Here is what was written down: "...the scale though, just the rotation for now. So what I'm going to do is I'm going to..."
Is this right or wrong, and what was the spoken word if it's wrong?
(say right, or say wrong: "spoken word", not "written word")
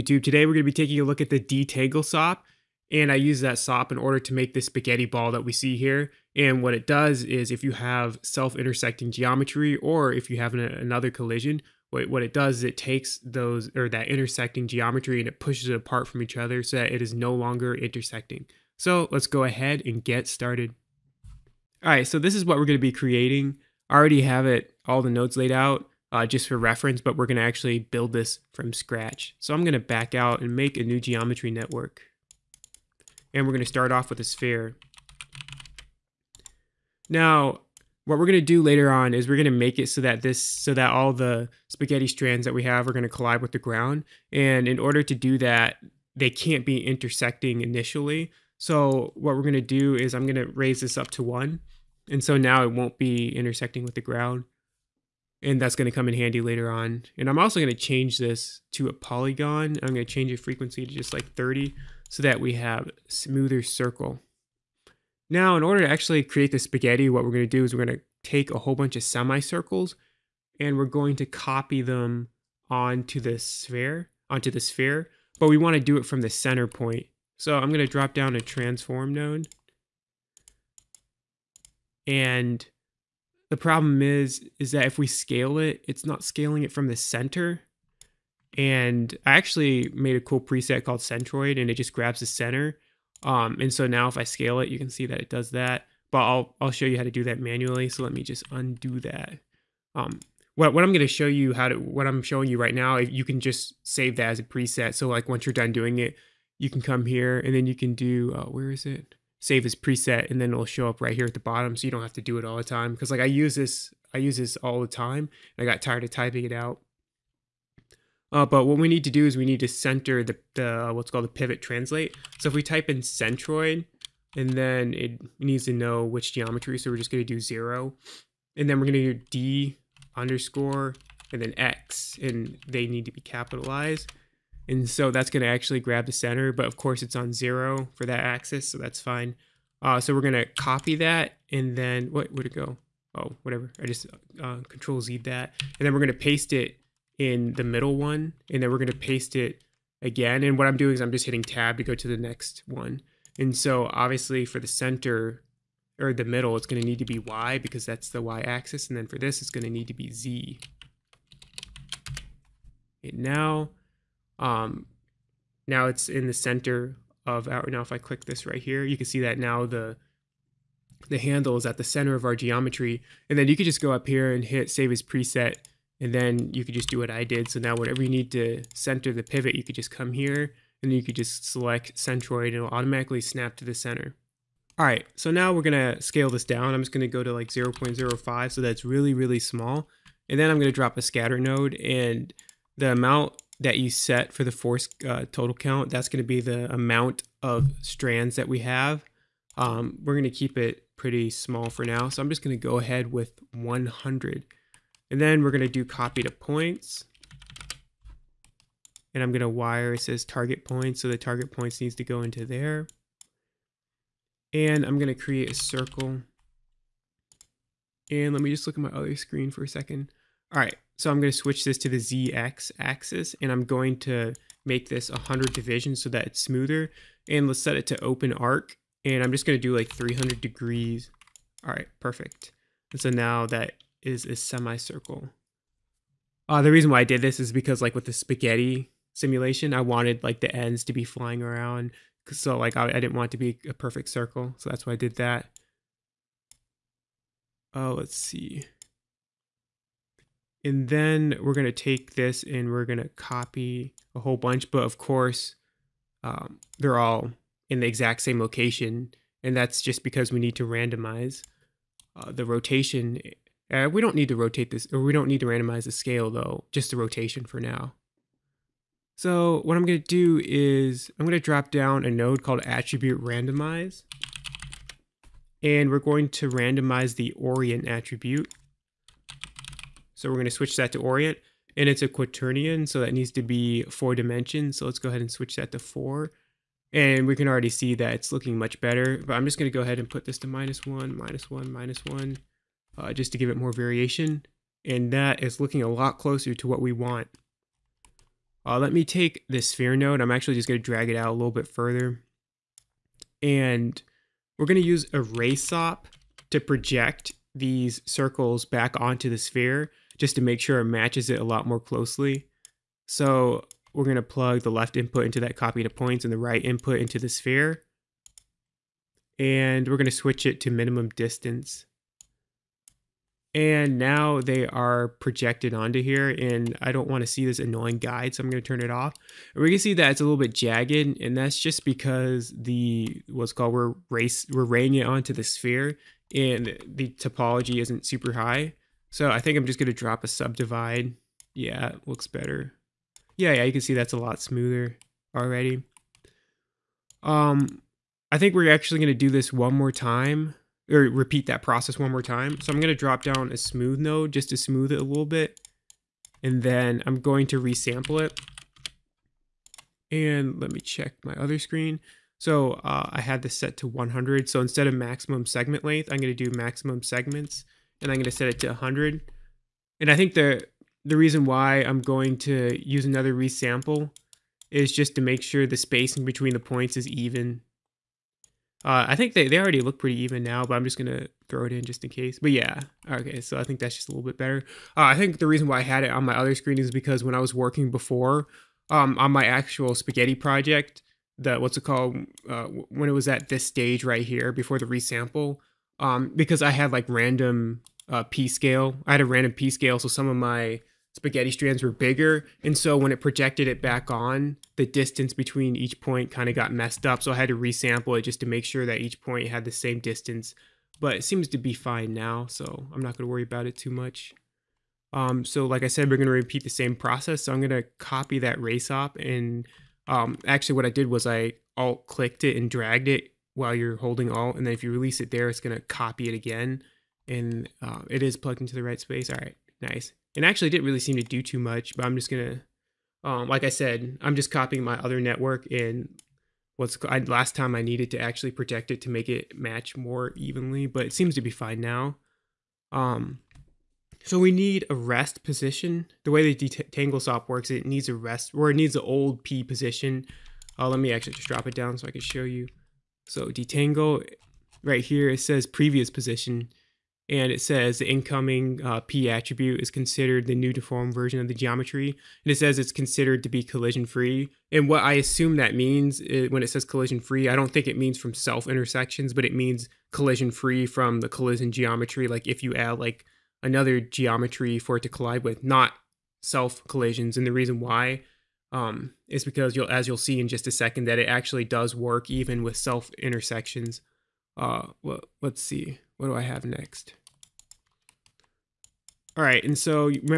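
right.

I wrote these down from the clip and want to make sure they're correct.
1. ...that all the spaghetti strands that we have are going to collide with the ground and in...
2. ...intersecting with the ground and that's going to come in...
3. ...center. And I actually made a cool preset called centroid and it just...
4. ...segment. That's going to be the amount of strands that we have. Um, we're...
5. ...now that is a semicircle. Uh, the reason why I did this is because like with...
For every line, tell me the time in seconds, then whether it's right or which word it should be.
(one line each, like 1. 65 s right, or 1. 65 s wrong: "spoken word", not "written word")
1. 40 s right
2. 53 s right
3. 86 s right
4. 195 s wrong: "count", not "segment"
5. 233 s right.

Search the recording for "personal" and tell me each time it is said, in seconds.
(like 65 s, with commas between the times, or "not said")
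not said.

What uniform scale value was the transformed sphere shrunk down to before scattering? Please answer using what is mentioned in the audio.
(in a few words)
0.05.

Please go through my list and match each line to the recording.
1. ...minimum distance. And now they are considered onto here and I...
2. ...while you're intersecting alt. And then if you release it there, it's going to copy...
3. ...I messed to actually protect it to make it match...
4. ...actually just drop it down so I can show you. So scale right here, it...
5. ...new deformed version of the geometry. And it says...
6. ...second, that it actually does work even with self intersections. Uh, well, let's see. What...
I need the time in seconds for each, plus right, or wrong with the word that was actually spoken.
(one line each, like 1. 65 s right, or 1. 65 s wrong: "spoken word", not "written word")
1. 320 s wrong: "projected", not "considered"
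2. 423 s wrong: "holding", not "intersecting"
3. 437 s wrong: "needed", not "messed"
4. 451 s wrong: "detangle", not "scale"
5. 460 s right
6. 480 s right.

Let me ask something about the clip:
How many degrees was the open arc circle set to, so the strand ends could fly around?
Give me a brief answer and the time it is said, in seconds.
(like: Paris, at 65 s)
300, at 229 s.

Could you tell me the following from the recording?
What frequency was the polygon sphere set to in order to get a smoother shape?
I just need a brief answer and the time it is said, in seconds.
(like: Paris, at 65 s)
30, at 61 s.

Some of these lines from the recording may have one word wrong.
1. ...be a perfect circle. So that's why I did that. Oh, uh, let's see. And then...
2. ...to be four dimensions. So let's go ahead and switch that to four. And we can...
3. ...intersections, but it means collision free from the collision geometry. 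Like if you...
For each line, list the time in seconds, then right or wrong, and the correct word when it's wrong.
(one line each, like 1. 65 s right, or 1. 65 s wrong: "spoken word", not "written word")
1. 243 s right
2. 283 s right
3. 468 s right.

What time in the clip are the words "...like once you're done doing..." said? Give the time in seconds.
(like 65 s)
105 s.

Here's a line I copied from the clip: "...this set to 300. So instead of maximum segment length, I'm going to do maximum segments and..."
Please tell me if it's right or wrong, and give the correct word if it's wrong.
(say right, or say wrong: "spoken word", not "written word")
wrong: "100", not "300".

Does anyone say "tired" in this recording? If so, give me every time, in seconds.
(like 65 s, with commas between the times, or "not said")
115 s.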